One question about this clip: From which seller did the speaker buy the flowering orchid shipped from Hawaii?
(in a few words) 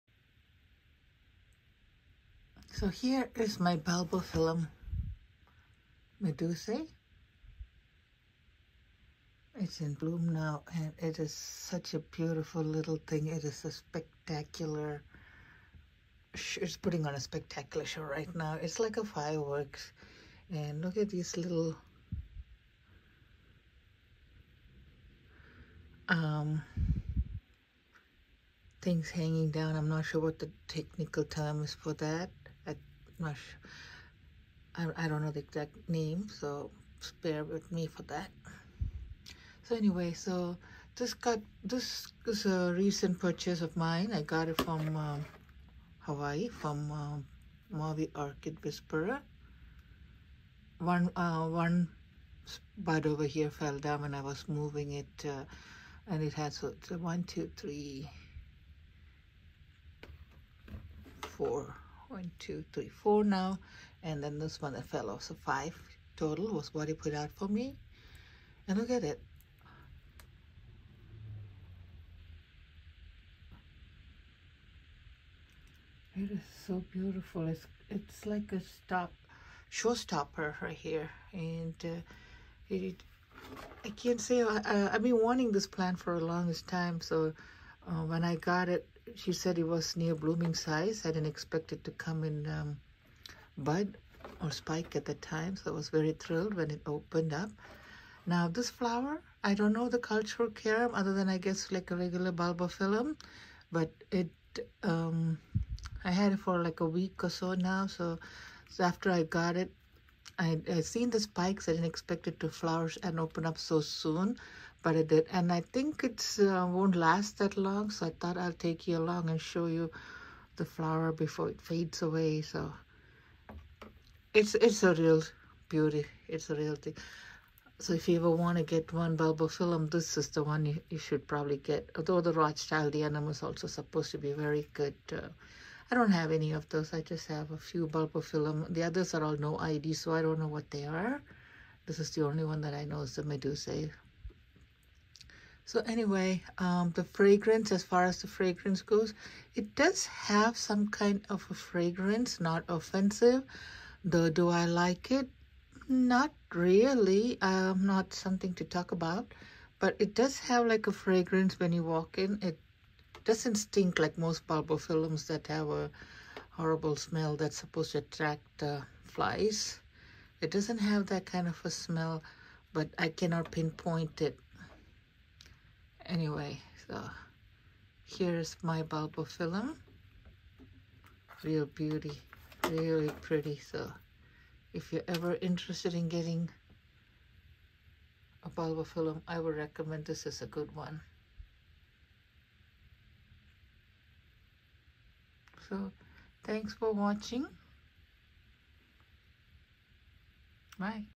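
Maui Orchid Whisperer.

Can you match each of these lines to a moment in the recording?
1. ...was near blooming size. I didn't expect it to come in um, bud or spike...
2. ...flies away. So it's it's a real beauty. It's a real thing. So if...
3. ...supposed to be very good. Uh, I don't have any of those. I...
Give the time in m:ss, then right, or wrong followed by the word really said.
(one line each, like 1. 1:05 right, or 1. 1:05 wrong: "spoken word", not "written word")
1. 1:29 right
2. 2:01 wrong: "fades", not "flies"
3. 2:13 right.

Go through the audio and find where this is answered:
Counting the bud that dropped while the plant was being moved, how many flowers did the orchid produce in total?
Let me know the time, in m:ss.
1:05.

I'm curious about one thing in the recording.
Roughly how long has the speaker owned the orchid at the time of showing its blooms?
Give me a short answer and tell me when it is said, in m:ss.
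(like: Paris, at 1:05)
a week, at 1:46.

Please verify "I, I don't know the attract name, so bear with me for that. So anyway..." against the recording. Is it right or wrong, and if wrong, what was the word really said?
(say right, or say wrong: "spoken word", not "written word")
wrong: "exact", not "attract".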